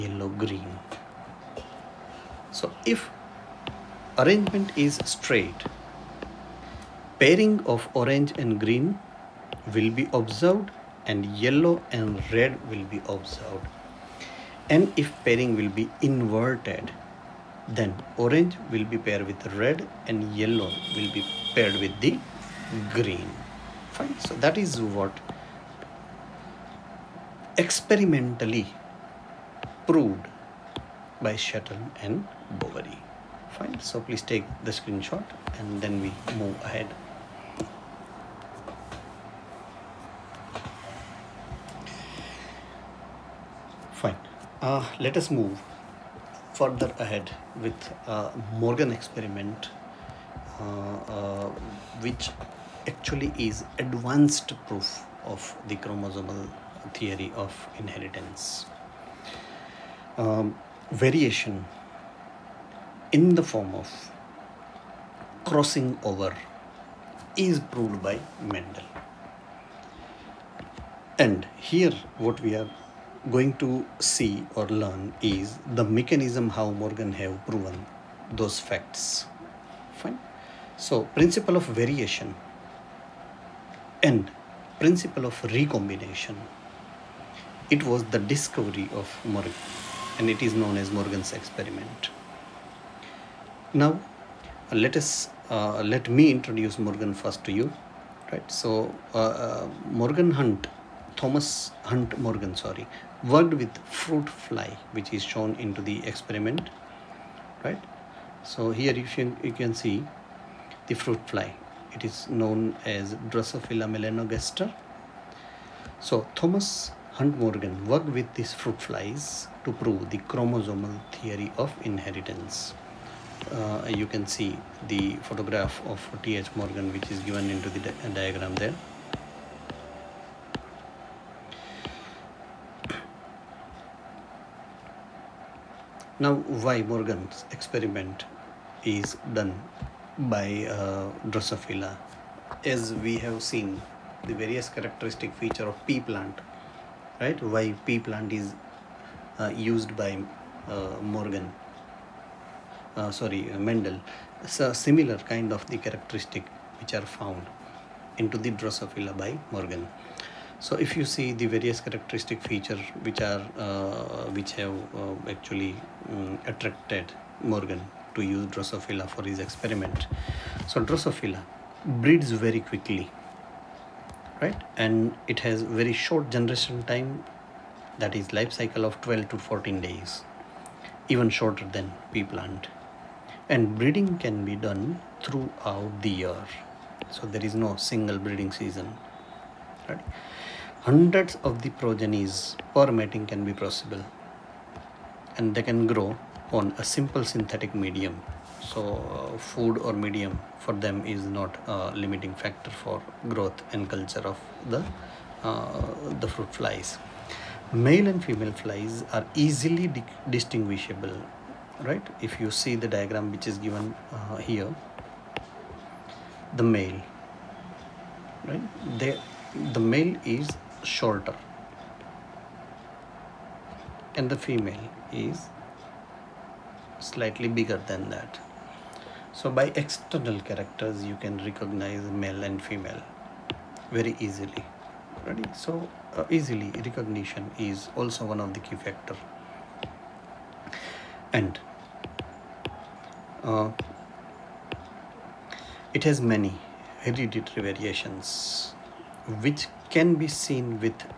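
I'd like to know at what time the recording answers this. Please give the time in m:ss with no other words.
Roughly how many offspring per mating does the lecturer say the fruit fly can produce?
3:10.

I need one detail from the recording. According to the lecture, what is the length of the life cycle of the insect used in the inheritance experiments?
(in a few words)
12 to 14 days.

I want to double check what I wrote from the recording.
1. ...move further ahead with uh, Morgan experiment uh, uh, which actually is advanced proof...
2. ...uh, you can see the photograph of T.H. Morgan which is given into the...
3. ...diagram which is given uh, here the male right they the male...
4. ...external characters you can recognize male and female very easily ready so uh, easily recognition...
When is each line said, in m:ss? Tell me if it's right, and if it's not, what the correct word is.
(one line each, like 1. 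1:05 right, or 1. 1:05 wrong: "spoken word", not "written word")
1. 0:45 right
2. 2:03 right
3. 3:32 right
4. 3:49 right.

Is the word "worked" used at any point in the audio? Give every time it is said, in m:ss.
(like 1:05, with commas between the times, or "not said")
1:43, 1:57.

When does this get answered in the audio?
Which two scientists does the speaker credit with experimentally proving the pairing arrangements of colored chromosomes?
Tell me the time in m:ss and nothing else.
0:31.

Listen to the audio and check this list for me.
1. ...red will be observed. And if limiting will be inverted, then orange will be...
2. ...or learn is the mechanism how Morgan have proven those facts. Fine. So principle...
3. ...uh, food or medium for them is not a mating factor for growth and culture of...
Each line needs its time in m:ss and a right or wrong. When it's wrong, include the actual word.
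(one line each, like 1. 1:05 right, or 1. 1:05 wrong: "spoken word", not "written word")
1. 0:12 wrong: "pairing", not "limiting"
2. 1:14 right
3. 3:18 wrong: "limiting", not "mating".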